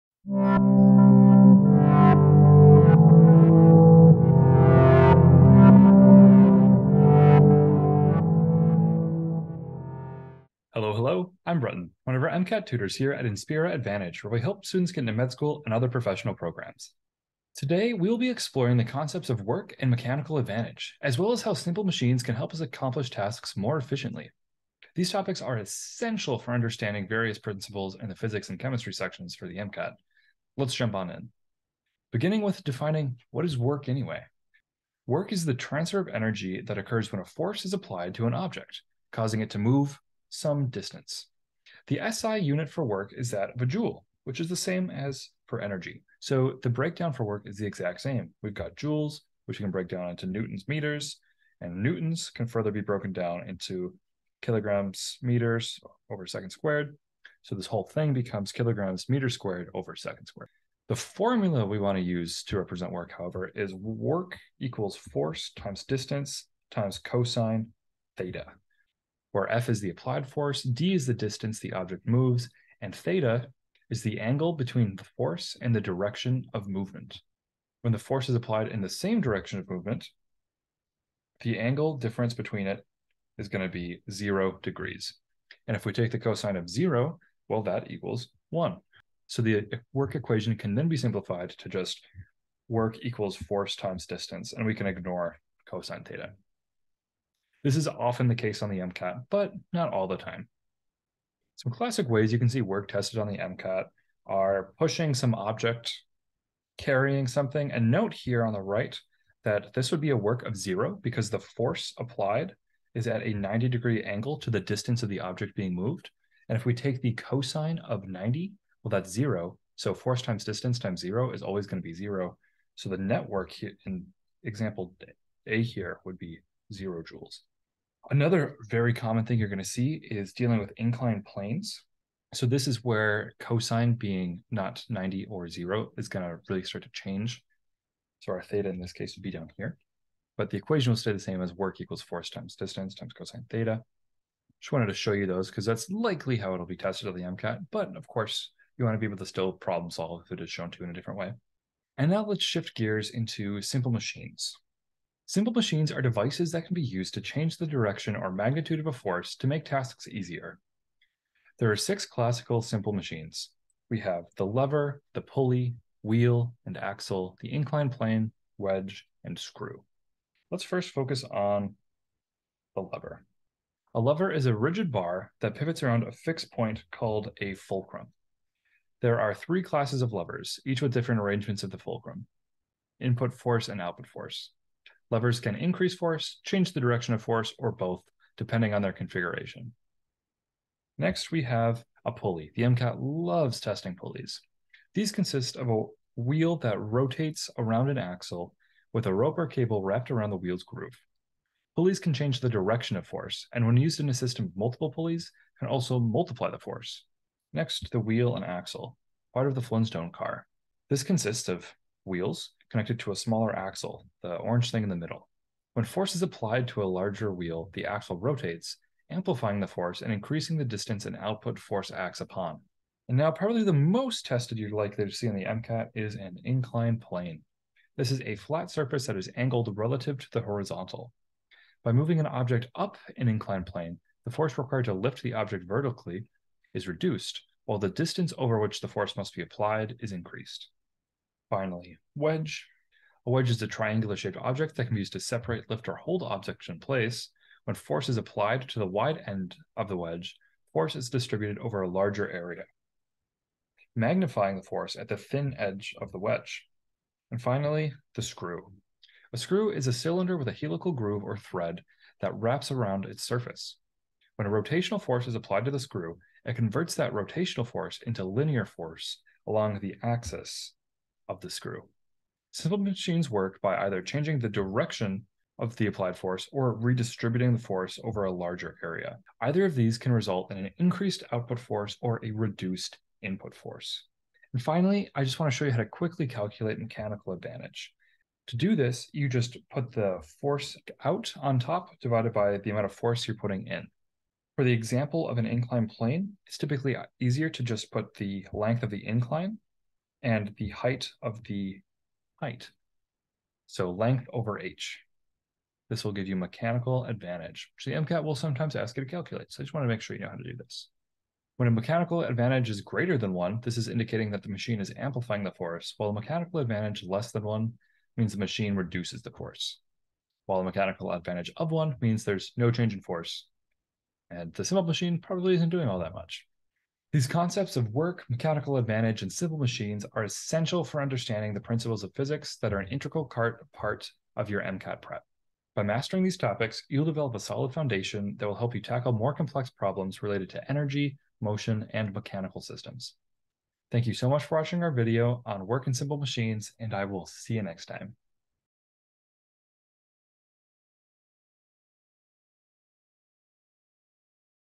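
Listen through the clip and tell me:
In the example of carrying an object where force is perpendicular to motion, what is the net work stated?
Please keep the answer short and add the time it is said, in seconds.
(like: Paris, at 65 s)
0 joules, at 126 s.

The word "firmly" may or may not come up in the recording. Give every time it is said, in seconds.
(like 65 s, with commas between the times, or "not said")
not said.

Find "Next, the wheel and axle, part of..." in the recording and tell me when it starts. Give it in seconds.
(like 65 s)
207 s.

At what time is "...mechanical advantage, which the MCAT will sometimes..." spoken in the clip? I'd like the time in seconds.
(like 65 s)
306 s.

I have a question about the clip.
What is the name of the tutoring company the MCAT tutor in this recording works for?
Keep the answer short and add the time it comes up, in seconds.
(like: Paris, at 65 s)
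Inspira Advantage, at 13 s.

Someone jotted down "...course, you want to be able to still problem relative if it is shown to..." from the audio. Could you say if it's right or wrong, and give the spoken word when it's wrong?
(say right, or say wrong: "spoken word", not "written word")
wrong: "solve", not "relative".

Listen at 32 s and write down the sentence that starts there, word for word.
Beginning with defining what is work anyway.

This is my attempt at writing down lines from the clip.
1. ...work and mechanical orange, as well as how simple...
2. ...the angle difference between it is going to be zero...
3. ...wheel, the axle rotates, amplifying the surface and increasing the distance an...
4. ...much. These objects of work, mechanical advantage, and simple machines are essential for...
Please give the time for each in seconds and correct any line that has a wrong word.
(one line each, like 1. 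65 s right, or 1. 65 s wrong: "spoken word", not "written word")
1. 19 s wrong: "advantage", not "orange"
2. 81 s right
3. 217 s wrong: "force", not "surface"
4. 326 s wrong: "concepts", not "objects".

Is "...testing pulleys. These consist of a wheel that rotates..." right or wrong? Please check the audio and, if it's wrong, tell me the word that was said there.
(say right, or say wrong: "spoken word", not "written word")
right.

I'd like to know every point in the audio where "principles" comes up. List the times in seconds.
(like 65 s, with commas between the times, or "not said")
27 s, 331 s.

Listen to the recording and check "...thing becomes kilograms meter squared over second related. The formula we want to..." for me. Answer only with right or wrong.
wrong.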